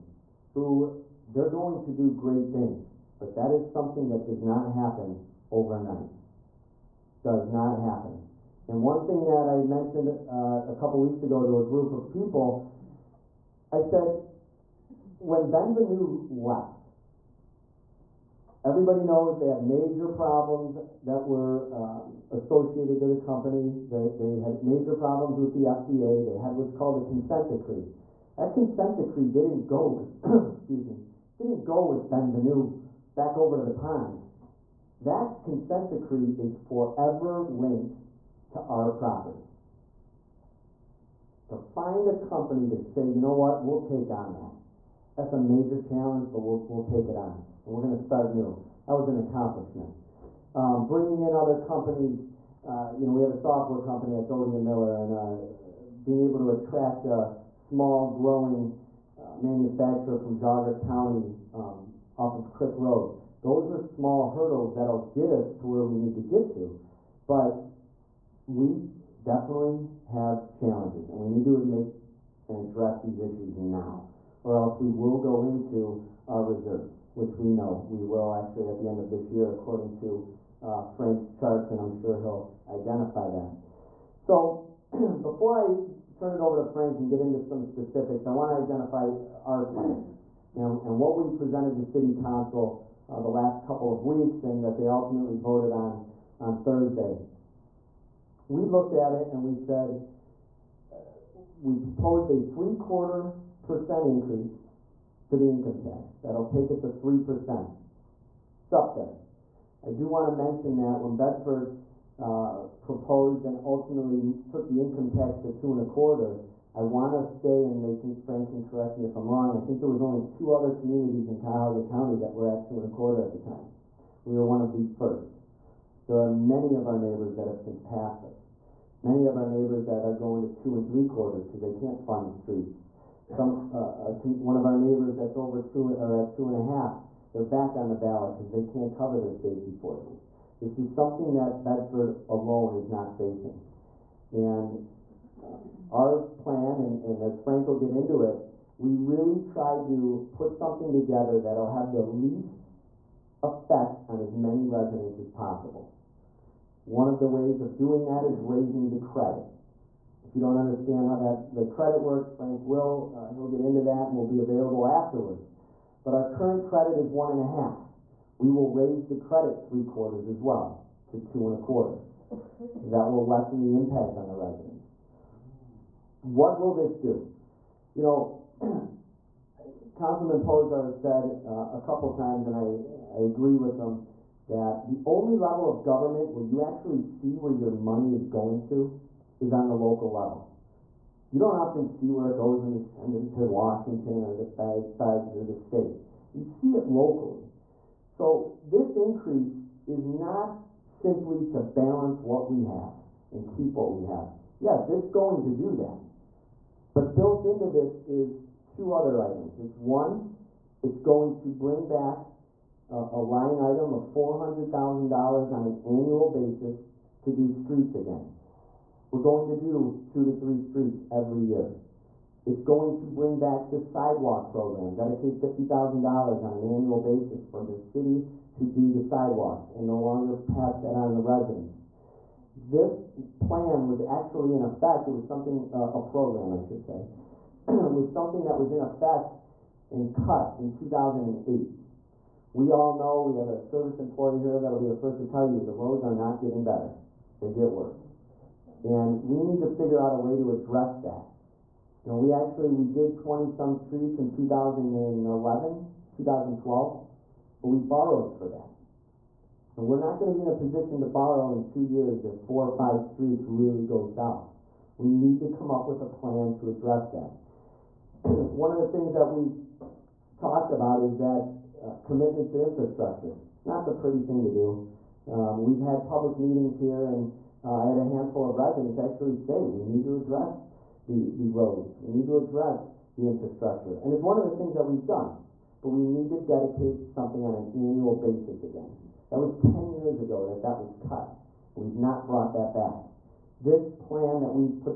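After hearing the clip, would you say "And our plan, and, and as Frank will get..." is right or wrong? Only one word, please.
right.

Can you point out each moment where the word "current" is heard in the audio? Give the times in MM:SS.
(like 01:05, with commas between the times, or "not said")
02:46.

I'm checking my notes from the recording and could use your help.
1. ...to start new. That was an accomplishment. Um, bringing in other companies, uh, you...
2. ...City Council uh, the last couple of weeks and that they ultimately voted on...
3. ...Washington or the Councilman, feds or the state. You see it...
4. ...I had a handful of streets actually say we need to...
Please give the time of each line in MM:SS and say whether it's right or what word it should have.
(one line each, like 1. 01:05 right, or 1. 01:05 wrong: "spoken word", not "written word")
1. 00:47 right
2. 01:31 right
3. 03:13 wrong: "Fed", not "Councilman"
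4. 04:37 wrong: "residents", not "streets".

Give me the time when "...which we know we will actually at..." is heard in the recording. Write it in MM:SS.
01:17.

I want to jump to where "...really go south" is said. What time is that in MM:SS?
04:23.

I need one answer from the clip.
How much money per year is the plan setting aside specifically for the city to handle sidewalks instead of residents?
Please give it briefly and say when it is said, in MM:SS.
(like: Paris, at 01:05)
$50,000, at 03:45.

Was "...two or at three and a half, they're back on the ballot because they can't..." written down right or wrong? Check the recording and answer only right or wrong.
wrong.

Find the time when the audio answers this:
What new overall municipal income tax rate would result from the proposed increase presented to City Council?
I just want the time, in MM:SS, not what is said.
01:46.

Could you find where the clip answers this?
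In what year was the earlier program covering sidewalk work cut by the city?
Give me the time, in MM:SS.
04:00.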